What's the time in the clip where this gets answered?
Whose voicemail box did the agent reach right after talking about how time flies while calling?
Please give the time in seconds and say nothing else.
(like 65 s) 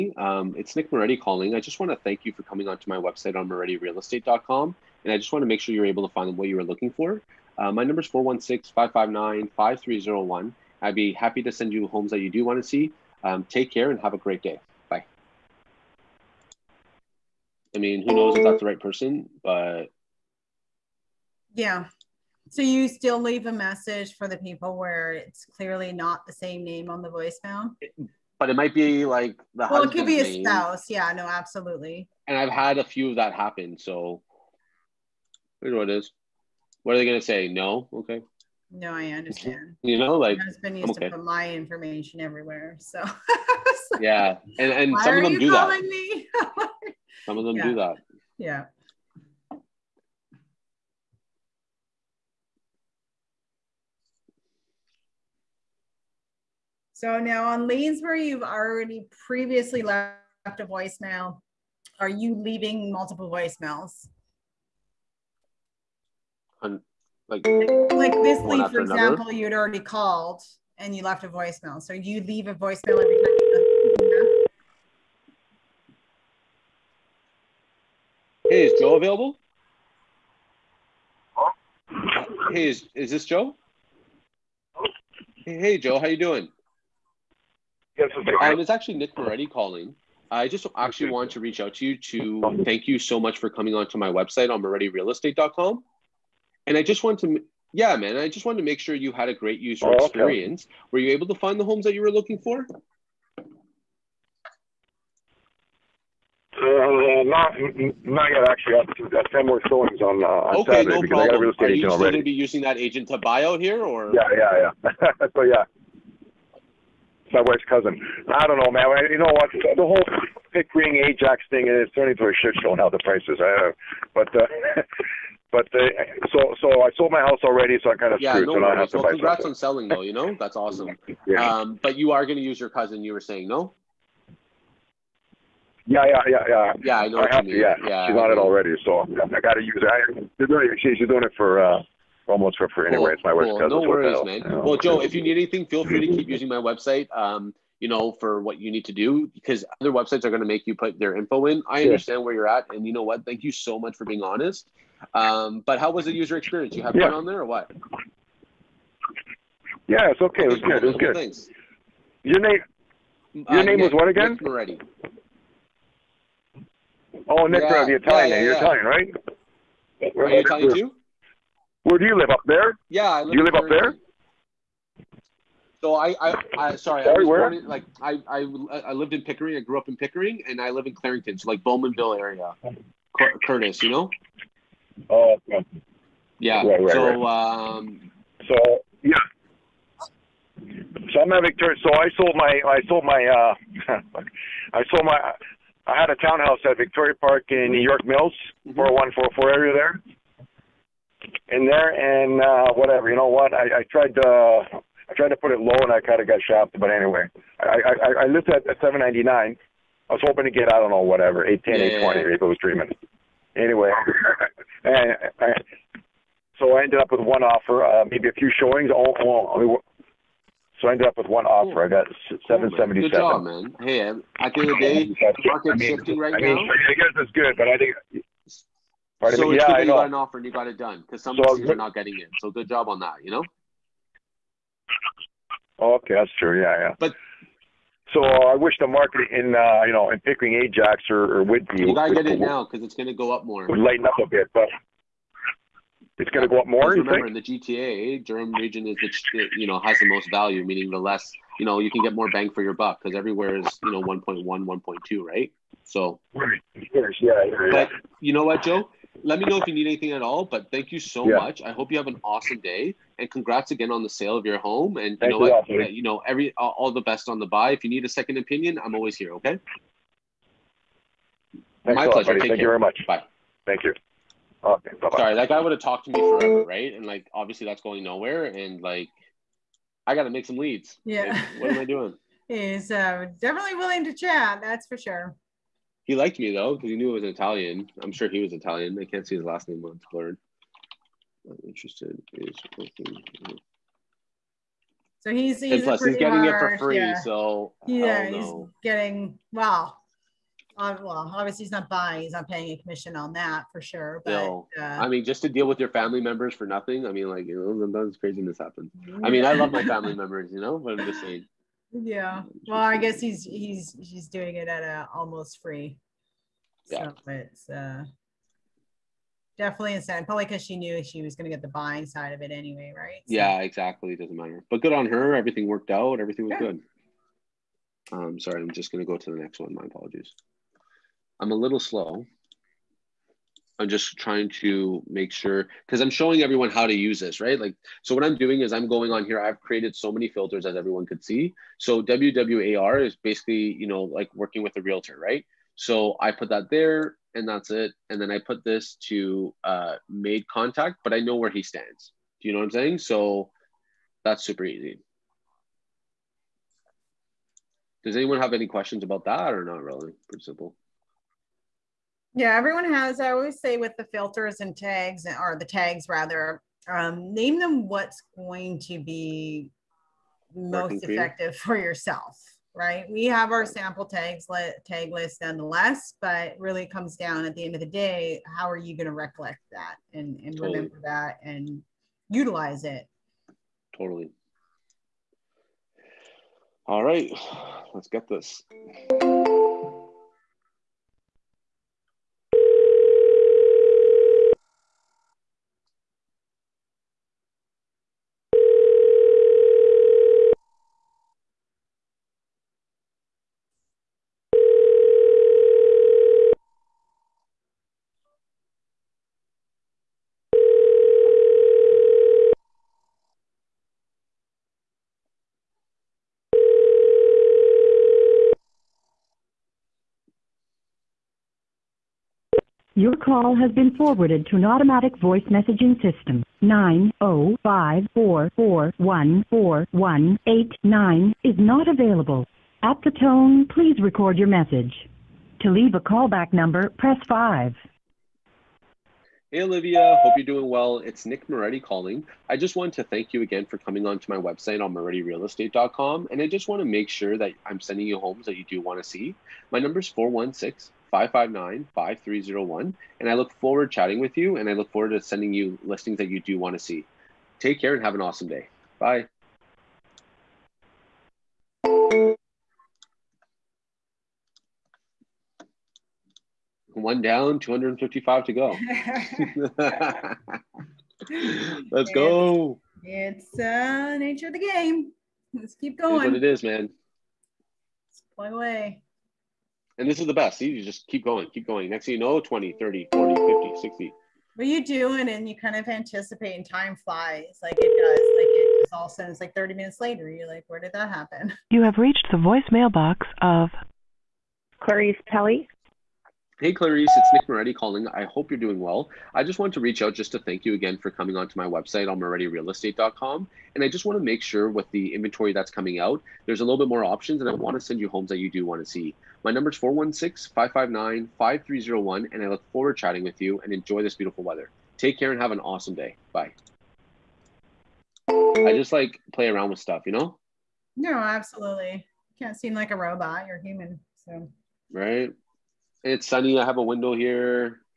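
494 s.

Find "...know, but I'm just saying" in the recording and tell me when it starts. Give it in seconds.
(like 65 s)
310 s.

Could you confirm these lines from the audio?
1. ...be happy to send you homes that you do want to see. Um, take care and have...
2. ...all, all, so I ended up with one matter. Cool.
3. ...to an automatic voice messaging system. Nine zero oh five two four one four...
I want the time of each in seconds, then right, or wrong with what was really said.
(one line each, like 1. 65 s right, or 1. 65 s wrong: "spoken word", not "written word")
1. 10 s right
2. 218 s wrong: "offer", not "matter"
3. 424 s wrong: "four", not "two".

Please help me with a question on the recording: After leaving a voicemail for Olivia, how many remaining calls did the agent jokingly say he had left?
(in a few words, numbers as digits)
255.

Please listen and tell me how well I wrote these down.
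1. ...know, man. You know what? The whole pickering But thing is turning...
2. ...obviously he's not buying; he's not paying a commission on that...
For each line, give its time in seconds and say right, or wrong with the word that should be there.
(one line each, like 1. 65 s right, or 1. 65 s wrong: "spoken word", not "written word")
1. 118 s wrong: "Ajax", not "But"
2. 301 s right.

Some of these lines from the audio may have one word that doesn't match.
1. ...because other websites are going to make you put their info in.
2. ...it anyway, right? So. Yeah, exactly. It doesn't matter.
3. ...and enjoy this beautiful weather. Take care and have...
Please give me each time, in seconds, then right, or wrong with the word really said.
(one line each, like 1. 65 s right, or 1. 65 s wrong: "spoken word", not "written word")
1. 149 s right
2. 322 s right
3. 513 s right.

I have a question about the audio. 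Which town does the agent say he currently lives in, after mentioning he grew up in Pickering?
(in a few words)
Clarington.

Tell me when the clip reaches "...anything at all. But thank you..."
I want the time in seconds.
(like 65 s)
259 s.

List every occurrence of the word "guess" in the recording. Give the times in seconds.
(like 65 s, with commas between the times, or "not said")
226 s, 312 s.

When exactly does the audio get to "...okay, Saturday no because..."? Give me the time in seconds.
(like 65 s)
110 s.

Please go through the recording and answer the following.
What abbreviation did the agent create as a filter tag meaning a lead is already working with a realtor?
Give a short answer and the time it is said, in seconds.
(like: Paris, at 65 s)
WWAR, at 342 s.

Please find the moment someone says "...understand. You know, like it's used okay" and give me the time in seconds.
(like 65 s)
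39 s.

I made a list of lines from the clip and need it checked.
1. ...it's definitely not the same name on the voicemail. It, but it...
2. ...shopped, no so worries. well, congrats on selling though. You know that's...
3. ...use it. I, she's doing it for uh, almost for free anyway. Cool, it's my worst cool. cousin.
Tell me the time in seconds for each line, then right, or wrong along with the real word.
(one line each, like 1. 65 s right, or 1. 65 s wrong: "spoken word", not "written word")
1. 25 s wrong: "clearly", not "definitely"
2. 128 s wrong: "screwed", not "shopped"
3. 139 s right.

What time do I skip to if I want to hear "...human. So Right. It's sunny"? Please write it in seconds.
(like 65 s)
523 s.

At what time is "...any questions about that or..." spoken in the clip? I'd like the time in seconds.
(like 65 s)
358 s.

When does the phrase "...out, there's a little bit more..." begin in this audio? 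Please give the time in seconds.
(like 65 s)
505 s.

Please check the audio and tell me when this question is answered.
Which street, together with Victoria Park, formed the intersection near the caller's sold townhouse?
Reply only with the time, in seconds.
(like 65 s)
197 s.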